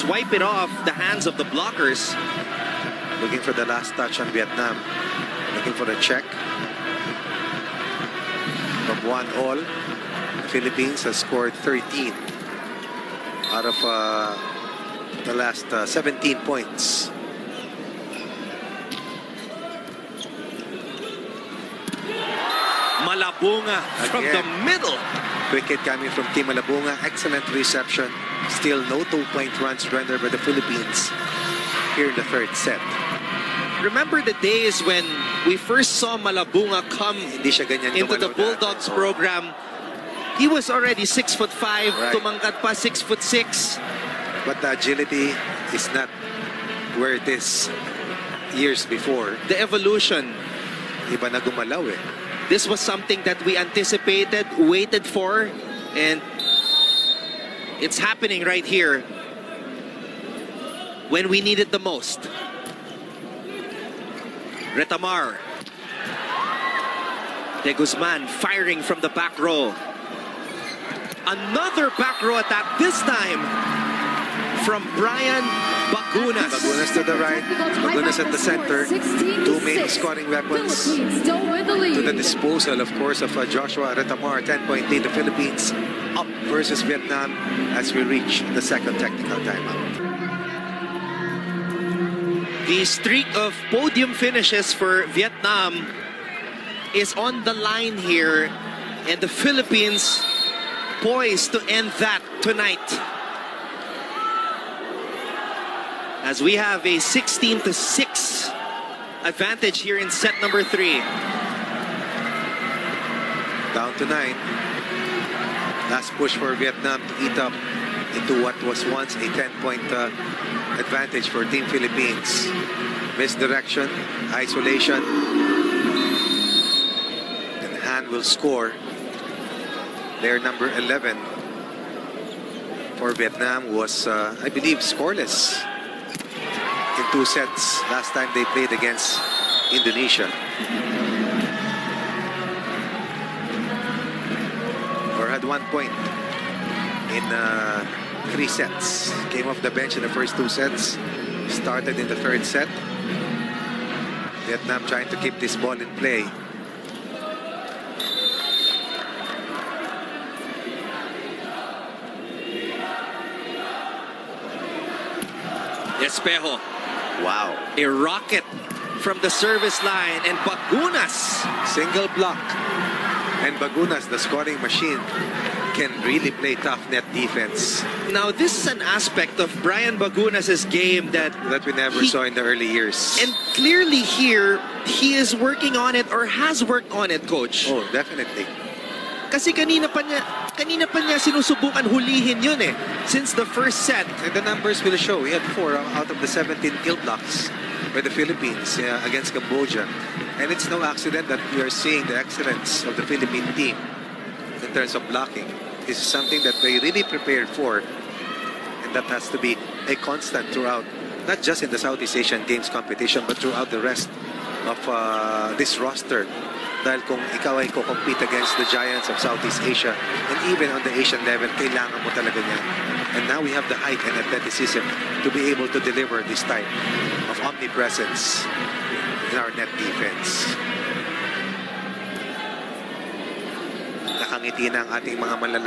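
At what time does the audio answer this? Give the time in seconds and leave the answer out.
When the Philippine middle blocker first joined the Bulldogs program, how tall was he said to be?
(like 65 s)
41 s.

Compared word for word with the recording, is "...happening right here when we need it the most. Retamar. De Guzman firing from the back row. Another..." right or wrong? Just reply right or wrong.
right.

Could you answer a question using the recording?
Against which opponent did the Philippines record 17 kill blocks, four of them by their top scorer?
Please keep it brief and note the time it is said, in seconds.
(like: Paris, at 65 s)
Cambodia, at 199 s.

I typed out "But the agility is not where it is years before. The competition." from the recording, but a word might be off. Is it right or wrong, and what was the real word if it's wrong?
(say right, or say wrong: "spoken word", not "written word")
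wrong: "evolution", not "competition".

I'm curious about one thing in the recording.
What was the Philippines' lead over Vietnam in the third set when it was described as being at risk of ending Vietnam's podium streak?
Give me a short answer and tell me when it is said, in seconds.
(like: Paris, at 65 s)
16 to 6, at 106 s.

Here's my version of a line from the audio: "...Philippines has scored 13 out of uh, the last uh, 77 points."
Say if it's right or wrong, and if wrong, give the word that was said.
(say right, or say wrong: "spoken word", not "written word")
wrong: "17", not "77".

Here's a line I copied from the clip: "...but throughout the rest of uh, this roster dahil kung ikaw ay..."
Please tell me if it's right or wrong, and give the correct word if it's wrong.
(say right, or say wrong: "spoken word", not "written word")
right.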